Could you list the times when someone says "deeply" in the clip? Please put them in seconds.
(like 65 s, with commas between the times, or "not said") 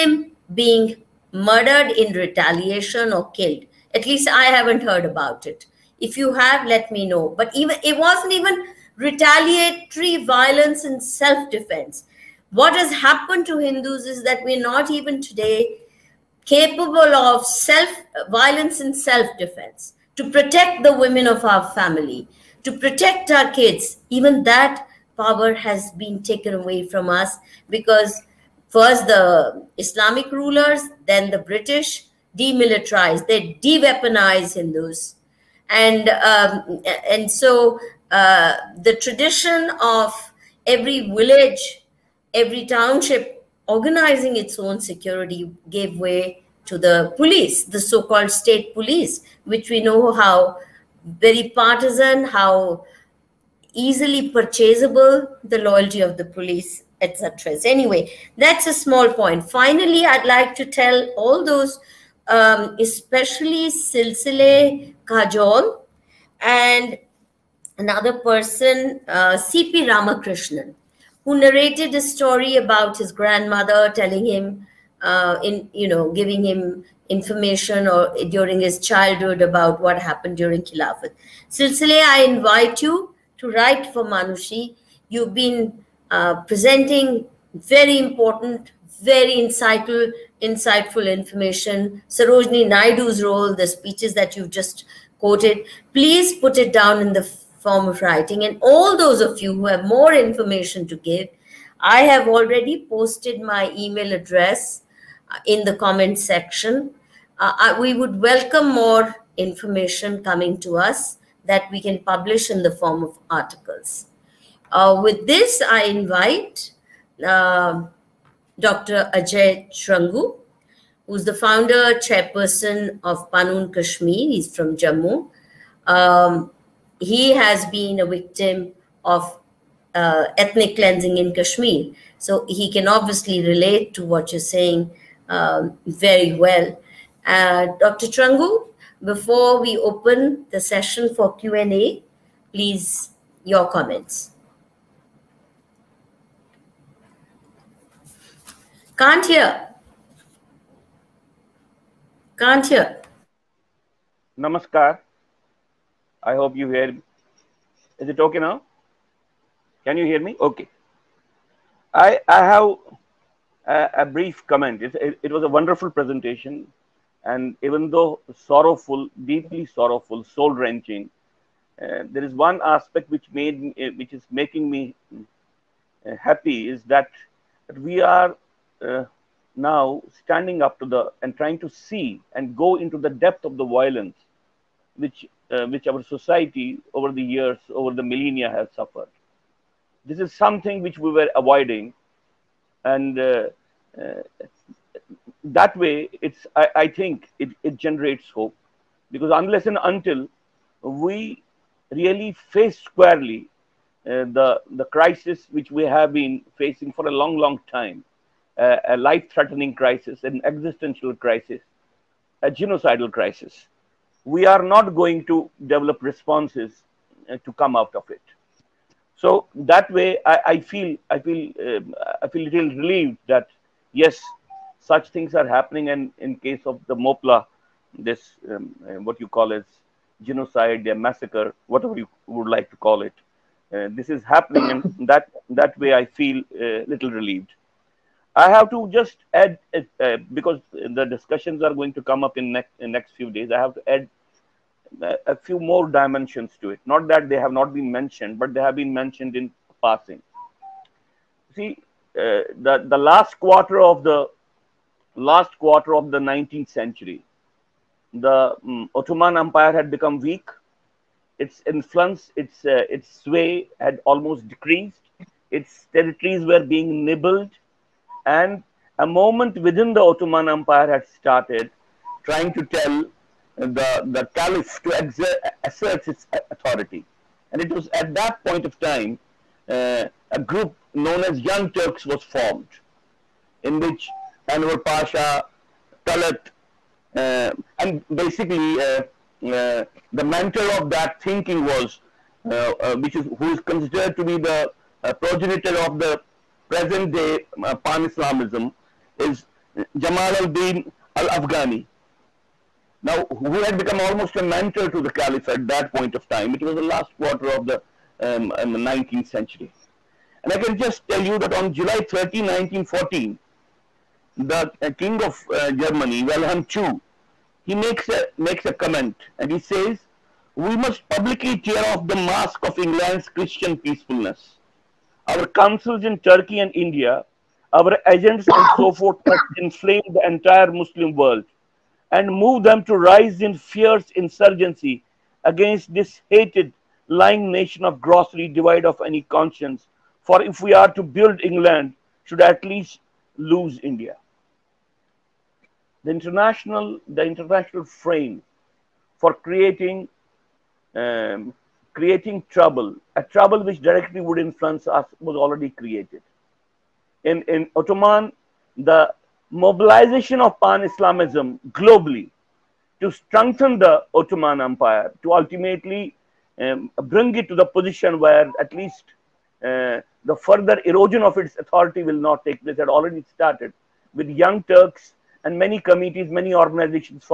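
169 s.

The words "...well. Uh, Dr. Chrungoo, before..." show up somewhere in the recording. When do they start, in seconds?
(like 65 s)
136 s.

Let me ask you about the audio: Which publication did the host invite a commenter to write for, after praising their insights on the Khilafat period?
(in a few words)
Manushi.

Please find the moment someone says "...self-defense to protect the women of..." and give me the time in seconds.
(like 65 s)
18 s.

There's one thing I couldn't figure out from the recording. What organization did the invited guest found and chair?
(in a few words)
Panun Kashmir.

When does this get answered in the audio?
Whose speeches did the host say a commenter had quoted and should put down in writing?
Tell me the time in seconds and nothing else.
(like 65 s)
92 s.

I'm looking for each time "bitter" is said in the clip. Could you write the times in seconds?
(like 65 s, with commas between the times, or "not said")
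not said.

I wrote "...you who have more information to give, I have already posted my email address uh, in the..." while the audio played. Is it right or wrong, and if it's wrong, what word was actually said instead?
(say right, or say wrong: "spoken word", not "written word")
right.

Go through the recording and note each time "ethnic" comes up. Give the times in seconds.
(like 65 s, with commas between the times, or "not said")
130 s.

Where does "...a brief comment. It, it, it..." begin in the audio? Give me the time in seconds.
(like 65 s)
163 s.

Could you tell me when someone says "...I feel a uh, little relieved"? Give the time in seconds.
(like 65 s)
235 s.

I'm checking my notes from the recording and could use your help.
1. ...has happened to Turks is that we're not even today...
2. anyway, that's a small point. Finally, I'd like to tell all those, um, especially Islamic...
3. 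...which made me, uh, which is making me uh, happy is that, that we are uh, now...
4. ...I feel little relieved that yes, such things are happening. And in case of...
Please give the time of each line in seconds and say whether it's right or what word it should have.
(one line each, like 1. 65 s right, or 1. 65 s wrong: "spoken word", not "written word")
1. 12 s wrong: "Hindus", not "Turks"
2. 57 s wrong: "Silsile", not "Islamic"
3. 173 s right
4. 222 s right.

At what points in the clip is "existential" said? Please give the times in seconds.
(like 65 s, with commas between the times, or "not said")
210 s.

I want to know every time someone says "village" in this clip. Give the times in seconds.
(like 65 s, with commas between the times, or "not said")
41 s.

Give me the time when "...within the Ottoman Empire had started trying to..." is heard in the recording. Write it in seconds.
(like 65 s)
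269 s.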